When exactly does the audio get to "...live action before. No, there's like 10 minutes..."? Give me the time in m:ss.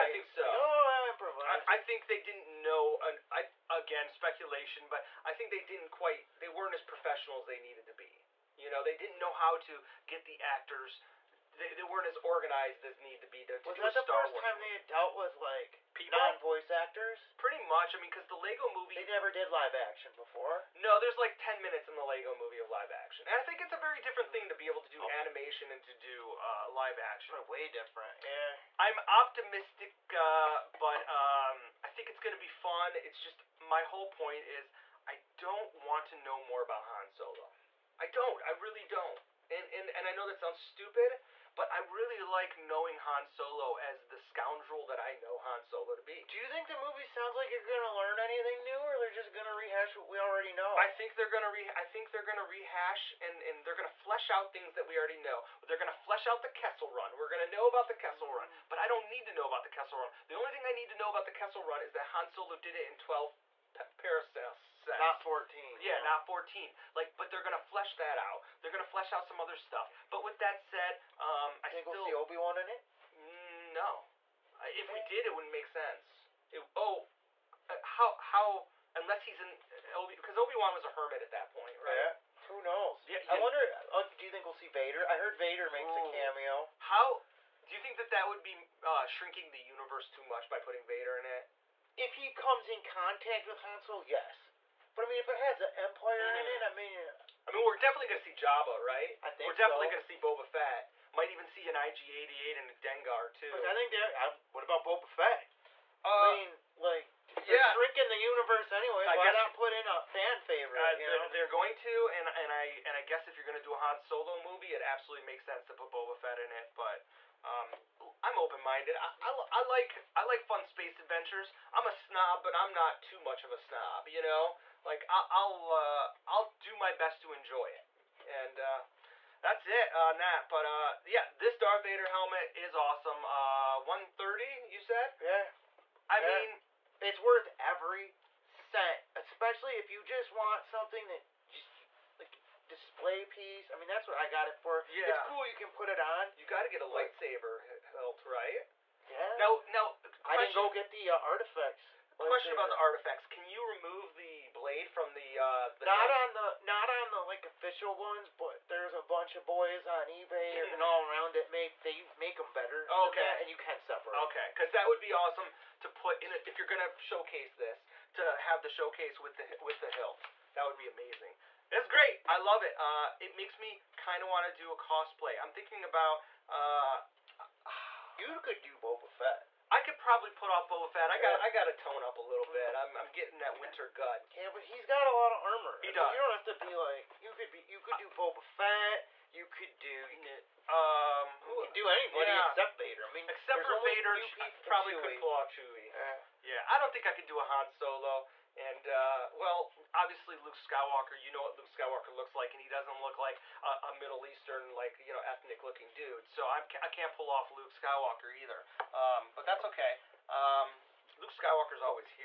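0:19.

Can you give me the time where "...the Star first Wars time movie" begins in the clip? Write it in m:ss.
0:13.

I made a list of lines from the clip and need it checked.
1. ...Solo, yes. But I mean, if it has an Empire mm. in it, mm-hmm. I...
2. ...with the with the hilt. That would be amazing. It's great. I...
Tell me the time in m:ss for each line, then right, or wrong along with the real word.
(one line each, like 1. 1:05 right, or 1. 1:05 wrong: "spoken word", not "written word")
1. 1:33 right
2. 2:49 right.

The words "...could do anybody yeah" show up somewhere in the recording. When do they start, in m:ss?
3:11.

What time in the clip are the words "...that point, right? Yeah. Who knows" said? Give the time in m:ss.
1:21.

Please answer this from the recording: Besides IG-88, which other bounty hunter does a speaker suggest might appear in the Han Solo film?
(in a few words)
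Dengar.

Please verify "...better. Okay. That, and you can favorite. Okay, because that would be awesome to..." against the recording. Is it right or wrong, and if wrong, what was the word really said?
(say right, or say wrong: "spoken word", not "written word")
wrong: "separate", not "favorite".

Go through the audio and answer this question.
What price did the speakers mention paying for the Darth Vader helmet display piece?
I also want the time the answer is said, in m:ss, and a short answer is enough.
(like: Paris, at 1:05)
130, at 2:13.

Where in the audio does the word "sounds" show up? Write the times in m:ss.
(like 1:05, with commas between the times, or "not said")
0:40, 0:47.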